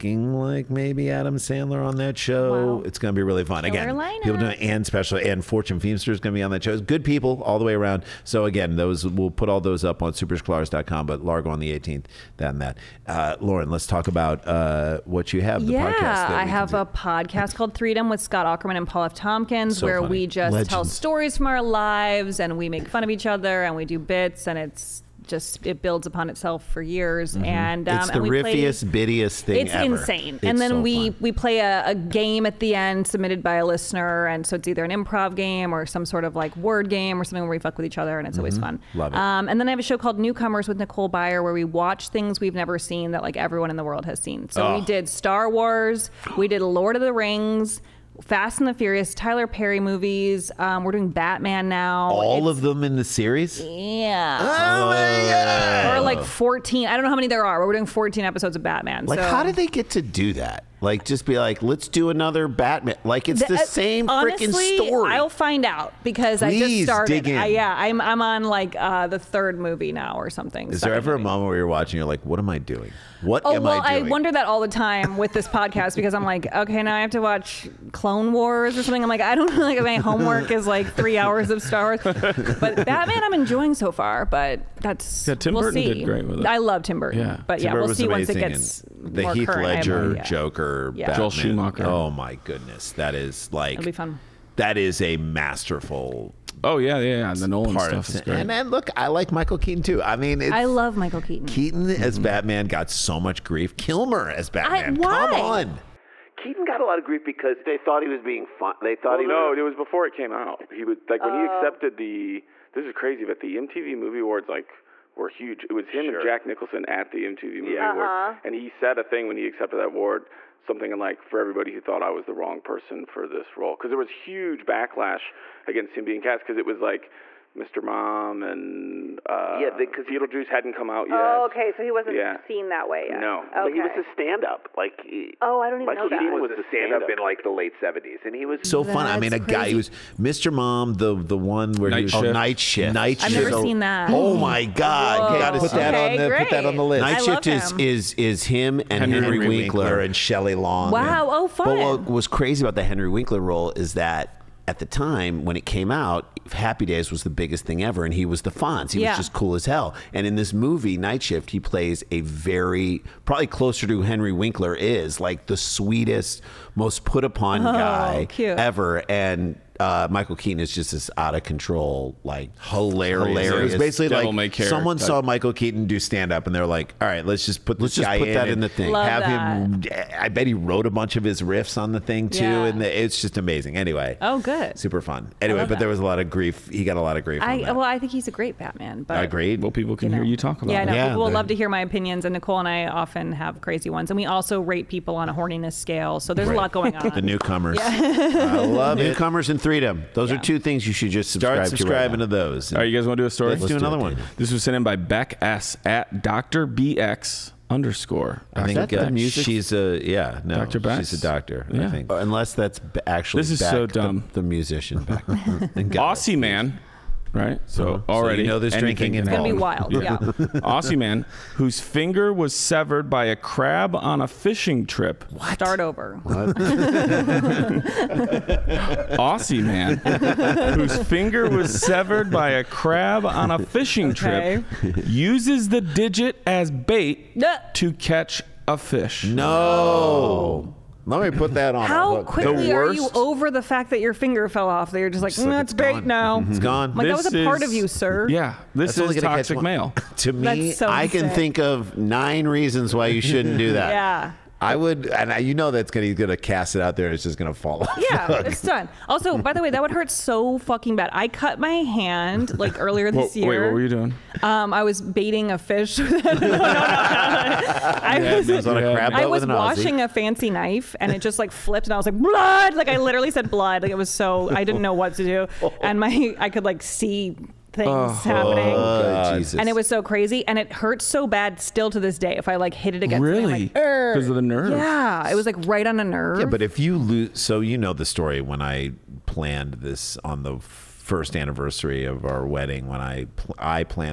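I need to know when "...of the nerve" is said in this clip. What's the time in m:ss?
4:44.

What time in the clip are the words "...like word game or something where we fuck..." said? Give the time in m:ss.
0:36.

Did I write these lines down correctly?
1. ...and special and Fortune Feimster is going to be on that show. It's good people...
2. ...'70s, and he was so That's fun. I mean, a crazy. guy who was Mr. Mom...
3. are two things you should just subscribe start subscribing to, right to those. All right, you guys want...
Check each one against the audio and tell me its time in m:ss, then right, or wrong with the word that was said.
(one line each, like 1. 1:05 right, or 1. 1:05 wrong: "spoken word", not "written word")
1. 0:04 right
2. 2:17 right
3. 3:20 right.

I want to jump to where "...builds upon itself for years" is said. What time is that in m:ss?
0:25.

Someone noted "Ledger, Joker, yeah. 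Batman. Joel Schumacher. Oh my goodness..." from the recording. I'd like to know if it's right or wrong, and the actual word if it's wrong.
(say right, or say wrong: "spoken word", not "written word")
right.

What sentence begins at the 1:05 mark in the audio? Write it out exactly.
I'll find out because Please I just started.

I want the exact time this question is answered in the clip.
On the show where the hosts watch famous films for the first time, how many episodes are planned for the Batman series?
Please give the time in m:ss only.
0:57.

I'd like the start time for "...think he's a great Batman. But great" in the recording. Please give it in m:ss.
3:07.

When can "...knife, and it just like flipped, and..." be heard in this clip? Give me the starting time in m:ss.
4:30.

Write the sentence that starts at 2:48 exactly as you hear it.
ever, and uh, Michael Keaton is just this out of control, like hilarious.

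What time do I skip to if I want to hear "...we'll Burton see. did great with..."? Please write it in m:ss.
1:25.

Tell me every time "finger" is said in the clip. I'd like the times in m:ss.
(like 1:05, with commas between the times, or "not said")
3:41, 3:51, 4:04.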